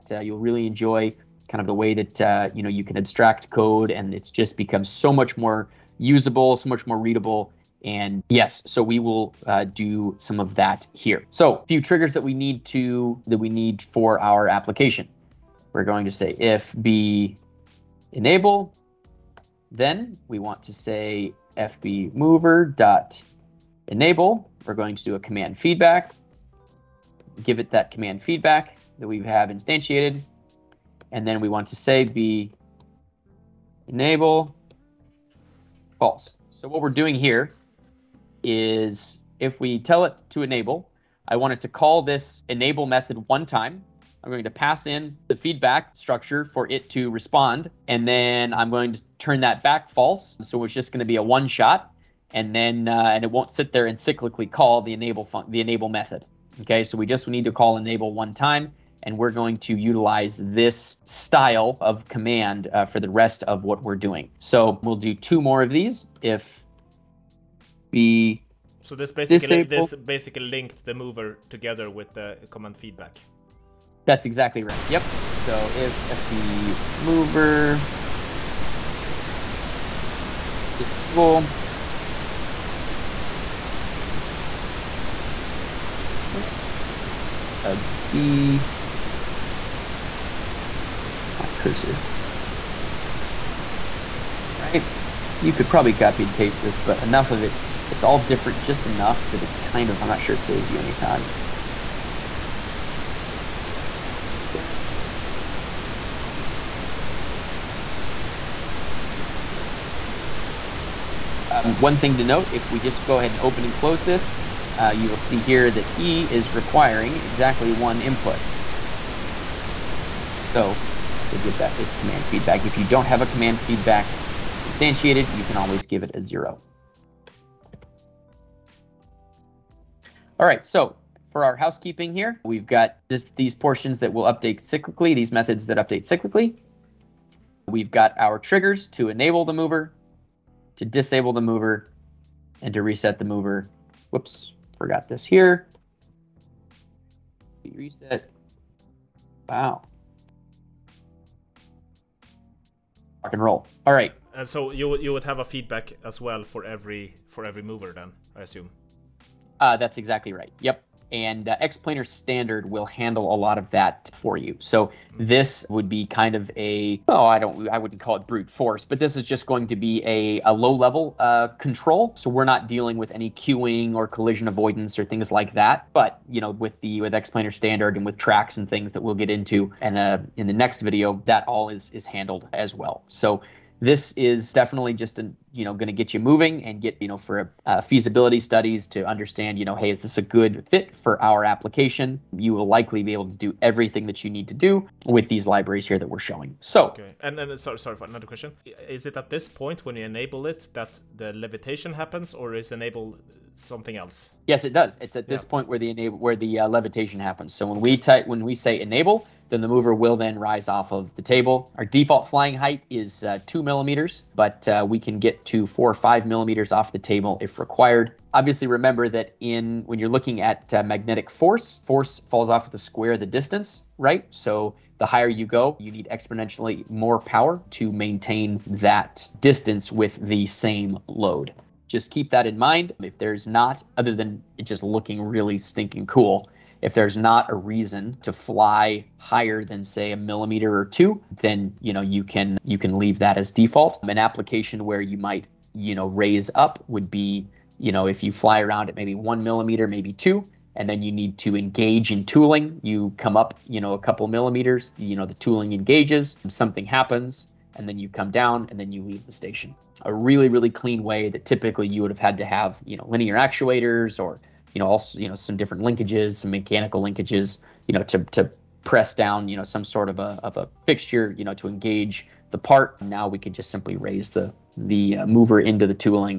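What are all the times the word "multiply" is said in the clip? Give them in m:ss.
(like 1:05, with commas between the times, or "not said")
not said.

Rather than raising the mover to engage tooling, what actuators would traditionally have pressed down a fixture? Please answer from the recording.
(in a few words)
linear actuators.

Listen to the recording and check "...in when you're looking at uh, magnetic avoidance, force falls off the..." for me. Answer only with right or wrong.
wrong.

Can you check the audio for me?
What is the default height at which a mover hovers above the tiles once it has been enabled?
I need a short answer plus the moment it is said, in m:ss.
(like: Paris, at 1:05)
2 millimeters, at 3:33.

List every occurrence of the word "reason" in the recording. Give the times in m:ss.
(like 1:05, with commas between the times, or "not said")
3:57.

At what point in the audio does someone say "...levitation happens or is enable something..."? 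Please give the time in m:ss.
3:21.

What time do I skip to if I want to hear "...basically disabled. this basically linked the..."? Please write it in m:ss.
1:09.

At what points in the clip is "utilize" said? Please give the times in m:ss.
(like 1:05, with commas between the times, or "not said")
0:59.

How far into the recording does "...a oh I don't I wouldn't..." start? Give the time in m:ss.
2:46.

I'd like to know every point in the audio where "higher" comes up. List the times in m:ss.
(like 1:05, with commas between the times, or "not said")
3:45, 3:59.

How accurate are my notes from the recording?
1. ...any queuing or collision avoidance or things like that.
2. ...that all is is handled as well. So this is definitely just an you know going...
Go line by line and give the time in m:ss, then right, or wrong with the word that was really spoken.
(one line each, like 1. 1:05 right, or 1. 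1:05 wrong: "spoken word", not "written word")
1. 2:53 right
2. 3:01 right.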